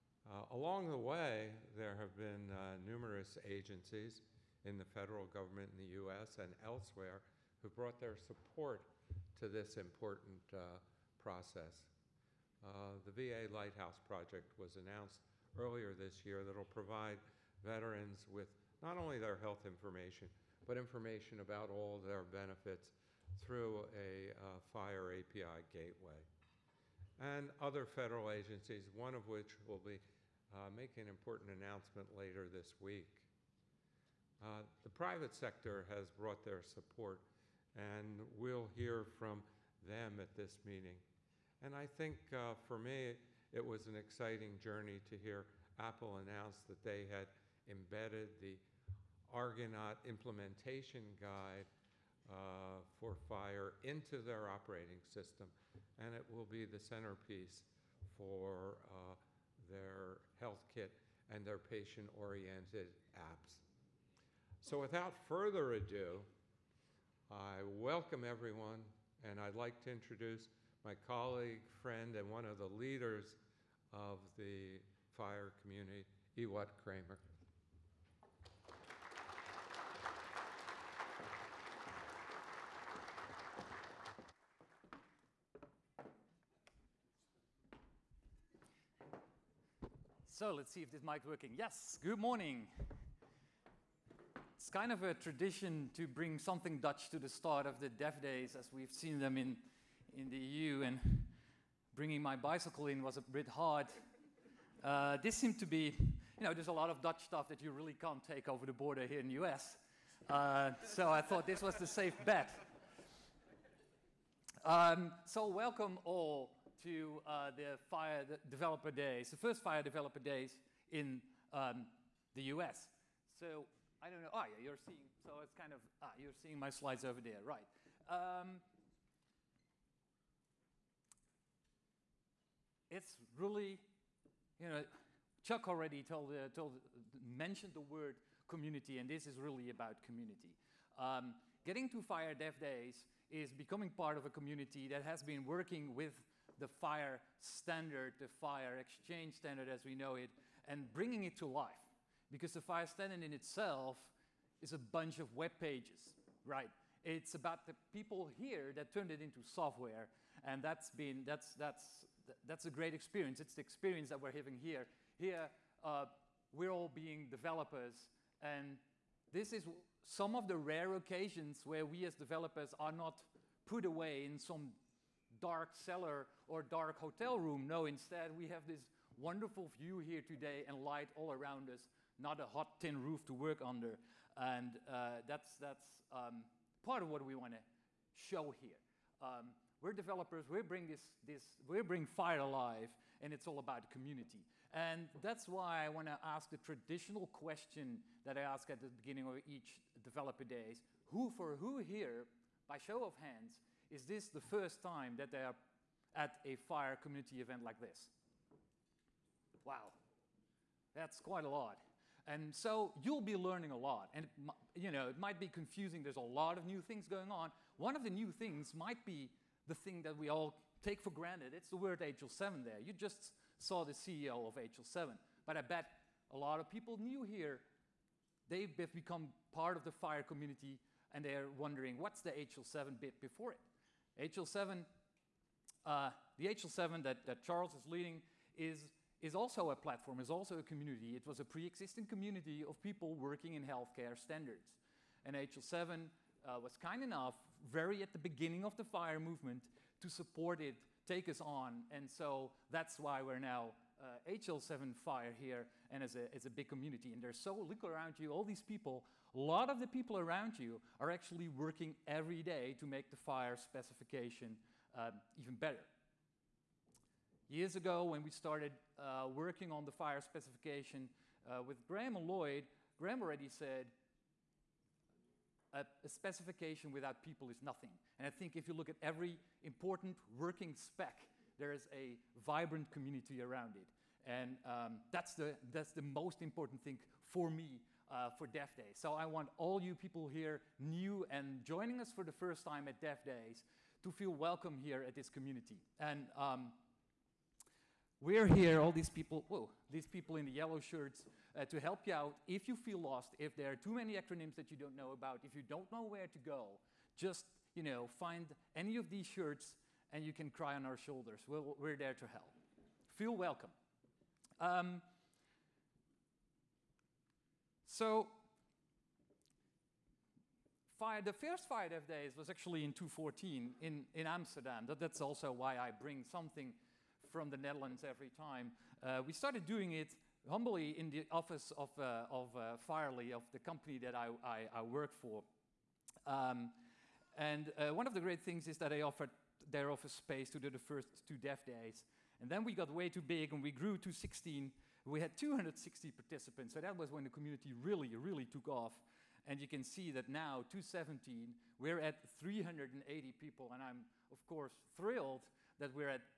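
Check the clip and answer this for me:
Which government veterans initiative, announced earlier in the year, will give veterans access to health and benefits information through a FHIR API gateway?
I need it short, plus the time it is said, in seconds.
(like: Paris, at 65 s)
VA Lighthouse Project, at 13 s.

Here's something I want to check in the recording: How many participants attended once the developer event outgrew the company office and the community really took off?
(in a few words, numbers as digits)
260.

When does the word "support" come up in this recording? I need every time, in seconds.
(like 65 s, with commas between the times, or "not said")
8 s, 36 s, 250 s.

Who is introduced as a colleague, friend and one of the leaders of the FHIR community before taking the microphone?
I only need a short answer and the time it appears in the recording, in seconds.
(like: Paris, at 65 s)
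Ewout Kramer, at 76 s.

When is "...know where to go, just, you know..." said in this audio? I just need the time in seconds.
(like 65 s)
305 s.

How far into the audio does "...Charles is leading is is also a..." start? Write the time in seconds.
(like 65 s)
237 s.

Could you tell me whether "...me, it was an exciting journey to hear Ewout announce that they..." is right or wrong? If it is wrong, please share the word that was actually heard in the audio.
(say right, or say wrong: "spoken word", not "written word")
wrong: "Apple", not "Ewout".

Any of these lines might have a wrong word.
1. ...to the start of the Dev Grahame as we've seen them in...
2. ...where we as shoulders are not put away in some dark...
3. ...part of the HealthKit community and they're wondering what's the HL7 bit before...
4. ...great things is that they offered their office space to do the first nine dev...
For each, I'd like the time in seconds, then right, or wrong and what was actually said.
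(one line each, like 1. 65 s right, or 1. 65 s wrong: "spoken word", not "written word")
1. 97 s wrong: "Days", not "Grahame"
2. 171 s wrong: "developers", not "shoulders"
3. 229 s wrong: "FHIR", not "HealthKit"
4. 338 s wrong: "two", not "nine".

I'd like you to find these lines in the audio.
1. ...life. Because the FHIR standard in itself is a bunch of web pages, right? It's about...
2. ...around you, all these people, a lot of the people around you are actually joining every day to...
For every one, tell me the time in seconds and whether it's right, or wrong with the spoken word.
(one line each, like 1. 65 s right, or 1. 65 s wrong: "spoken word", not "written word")
1. 151 s right
2. 257 s wrong: "working", not "joining".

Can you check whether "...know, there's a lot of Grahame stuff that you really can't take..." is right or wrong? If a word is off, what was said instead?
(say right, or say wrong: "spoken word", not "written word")
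wrong: "Dutch", not "Grahame".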